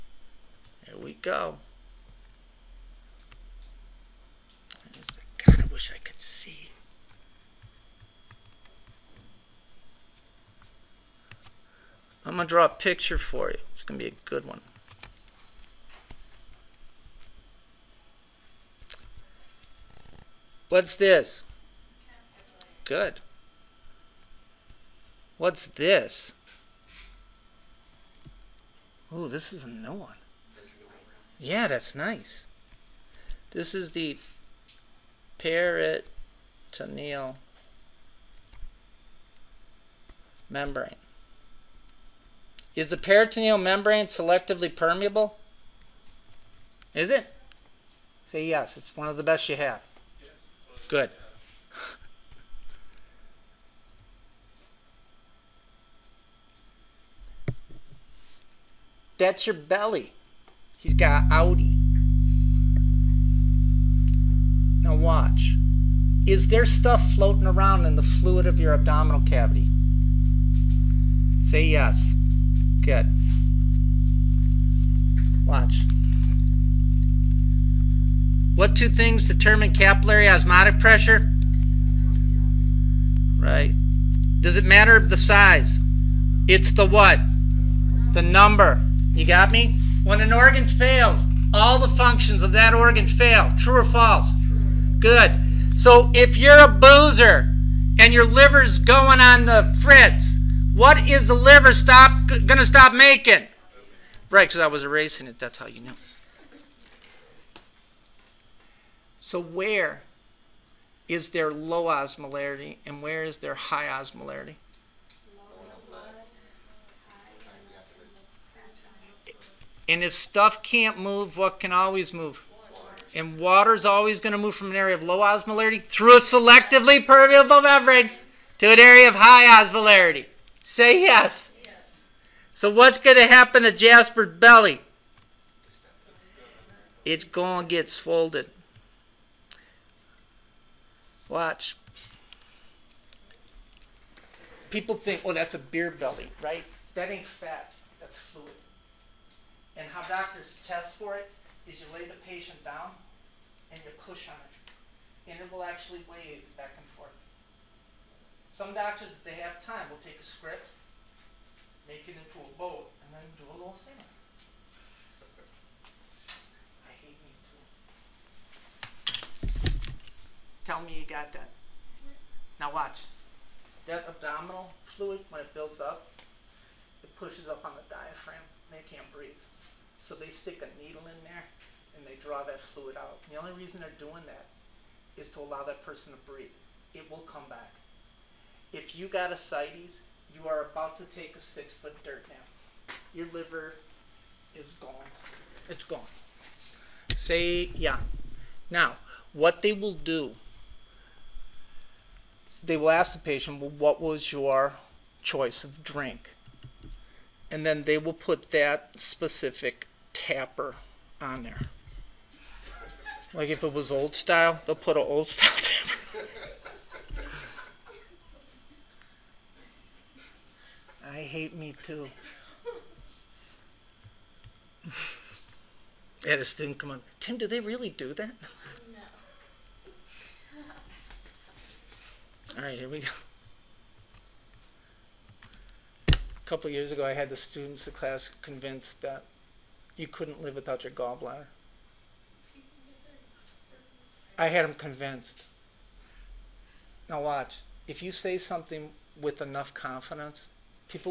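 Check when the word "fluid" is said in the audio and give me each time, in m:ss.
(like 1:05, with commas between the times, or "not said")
1:08, 2:28, 2:54, 3:02.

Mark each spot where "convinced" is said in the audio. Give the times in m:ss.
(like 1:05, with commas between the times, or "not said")
3:58, 4:04.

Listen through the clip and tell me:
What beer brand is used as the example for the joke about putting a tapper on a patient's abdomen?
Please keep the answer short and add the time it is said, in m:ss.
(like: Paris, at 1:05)
Old Style, at 3:33.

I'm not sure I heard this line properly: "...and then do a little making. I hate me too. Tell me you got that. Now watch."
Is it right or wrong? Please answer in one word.
wrong.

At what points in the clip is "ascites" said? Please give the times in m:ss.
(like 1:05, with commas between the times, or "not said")
3:09.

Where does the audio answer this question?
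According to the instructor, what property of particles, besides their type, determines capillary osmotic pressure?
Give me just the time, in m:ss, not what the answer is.
1:28.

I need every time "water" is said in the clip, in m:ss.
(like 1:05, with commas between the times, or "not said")
2:03.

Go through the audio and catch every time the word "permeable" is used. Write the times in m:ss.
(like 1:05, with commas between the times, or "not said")
0:44, 2:07.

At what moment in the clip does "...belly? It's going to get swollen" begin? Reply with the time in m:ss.
2:14.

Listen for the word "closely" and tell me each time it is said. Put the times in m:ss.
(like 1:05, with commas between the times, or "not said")
not said.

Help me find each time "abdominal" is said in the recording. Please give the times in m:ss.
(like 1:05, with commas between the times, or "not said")
1:08, 2:54.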